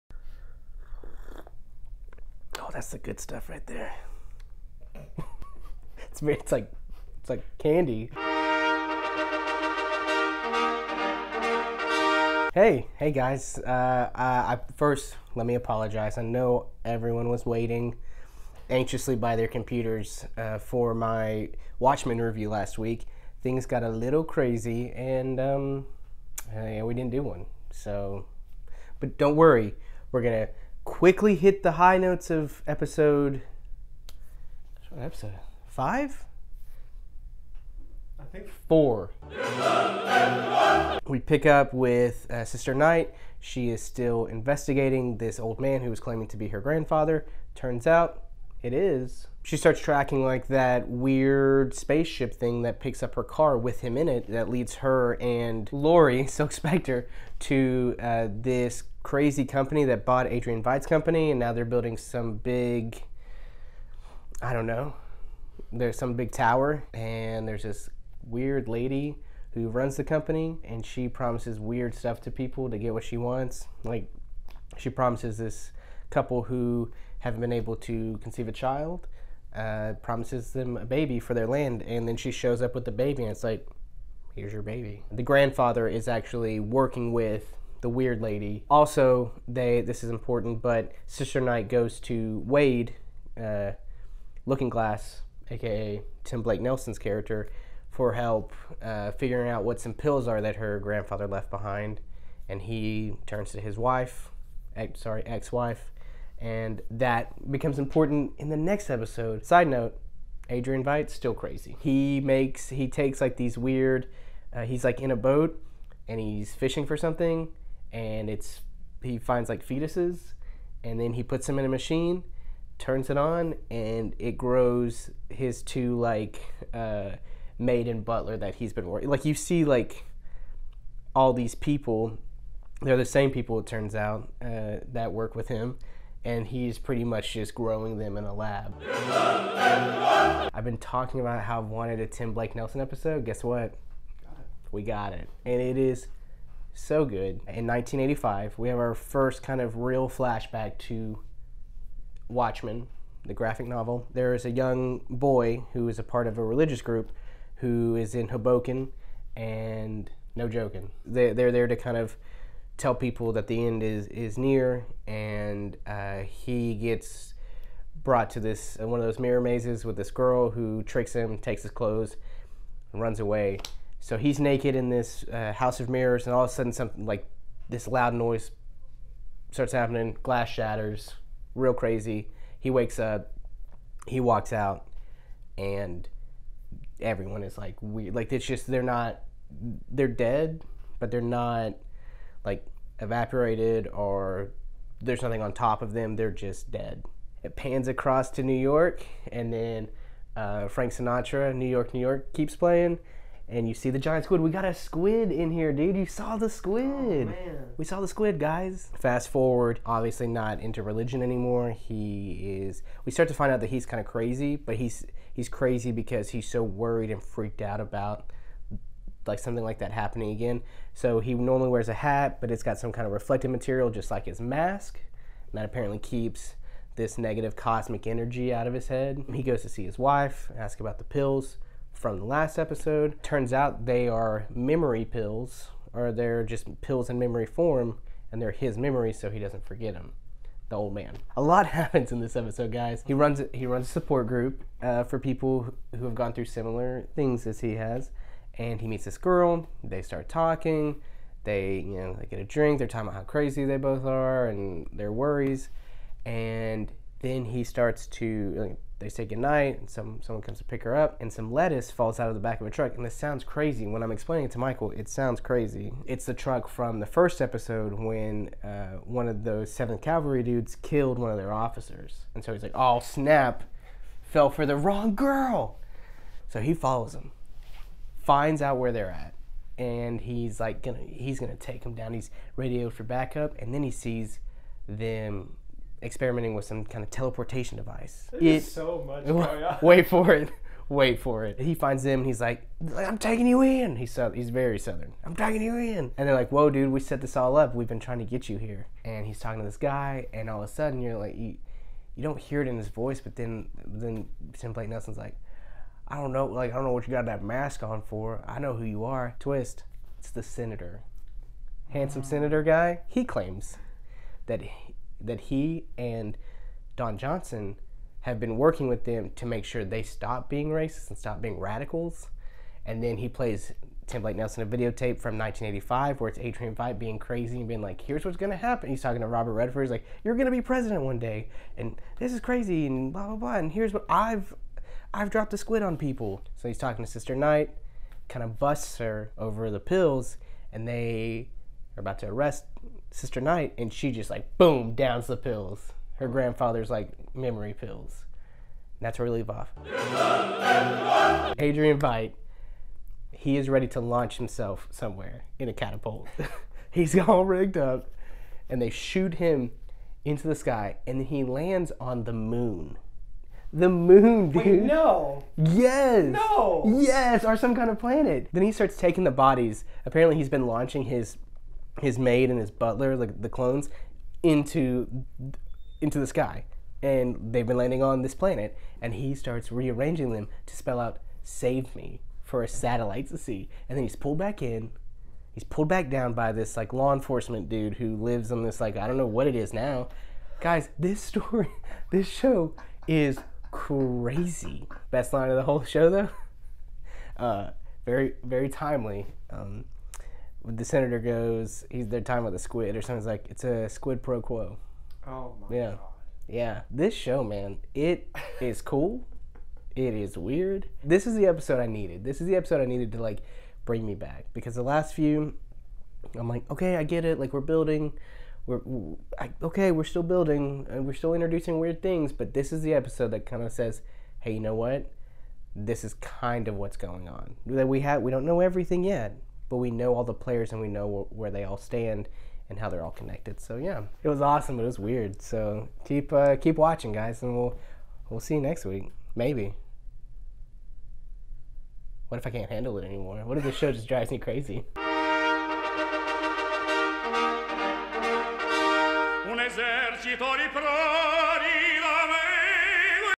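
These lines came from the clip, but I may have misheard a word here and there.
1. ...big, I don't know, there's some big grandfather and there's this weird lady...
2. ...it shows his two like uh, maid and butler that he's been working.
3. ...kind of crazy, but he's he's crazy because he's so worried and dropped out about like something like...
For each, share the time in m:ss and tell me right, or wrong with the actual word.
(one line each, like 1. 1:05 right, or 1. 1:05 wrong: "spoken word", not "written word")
1. 1:02 wrong: "tower", not "grandfather"
2. 2:04 wrong: "grows", not "shows"
3. 3:33 wrong: "freaked", not "dropped".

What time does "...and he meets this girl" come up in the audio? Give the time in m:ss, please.
4:08.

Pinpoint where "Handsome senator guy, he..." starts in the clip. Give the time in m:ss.
5:11.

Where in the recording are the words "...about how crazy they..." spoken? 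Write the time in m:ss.
4:13.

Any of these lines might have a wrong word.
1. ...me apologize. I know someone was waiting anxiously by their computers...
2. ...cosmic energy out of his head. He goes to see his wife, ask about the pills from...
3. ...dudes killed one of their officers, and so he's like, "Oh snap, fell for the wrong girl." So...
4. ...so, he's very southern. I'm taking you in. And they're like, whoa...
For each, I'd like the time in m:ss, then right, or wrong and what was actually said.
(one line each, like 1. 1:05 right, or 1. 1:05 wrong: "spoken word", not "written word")
1. 0:15 wrong: "everyone", not "someone"
2. 3:47 right
3. 4:30 right
4. 4:54 right.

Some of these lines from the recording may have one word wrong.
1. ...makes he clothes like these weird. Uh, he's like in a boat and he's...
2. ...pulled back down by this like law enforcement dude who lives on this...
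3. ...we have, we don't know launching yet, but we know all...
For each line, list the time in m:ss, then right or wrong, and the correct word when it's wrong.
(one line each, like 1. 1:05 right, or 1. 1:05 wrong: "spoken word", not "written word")
1. 1:52 wrong: "takes", not "clothes"
2. 6:25 right
3. 7:07 wrong: "everything", not "launching".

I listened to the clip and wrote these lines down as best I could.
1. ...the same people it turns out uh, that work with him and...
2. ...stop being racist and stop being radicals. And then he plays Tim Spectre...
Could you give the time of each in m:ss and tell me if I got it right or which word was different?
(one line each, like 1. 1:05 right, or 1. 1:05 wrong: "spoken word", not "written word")
1. 2:12 right
2. 5:20 wrong: "Blake", not "Spectre".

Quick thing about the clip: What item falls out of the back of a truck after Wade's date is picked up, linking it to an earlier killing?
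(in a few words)
Lettuce.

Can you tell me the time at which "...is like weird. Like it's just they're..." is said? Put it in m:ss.
3:07.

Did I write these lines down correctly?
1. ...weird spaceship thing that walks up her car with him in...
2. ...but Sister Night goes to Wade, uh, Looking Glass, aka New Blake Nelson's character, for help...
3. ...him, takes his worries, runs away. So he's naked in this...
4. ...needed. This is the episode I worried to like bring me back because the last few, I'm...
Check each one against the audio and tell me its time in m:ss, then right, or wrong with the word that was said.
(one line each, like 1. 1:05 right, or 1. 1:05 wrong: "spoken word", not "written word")
1. 0:50 wrong: "picks", not "walks"
2. 1:30 wrong: "Tim", not "New"
3. 2:51 wrong: "clothes", not "worries"
4. 6:51 wrong: "needed", not "worried".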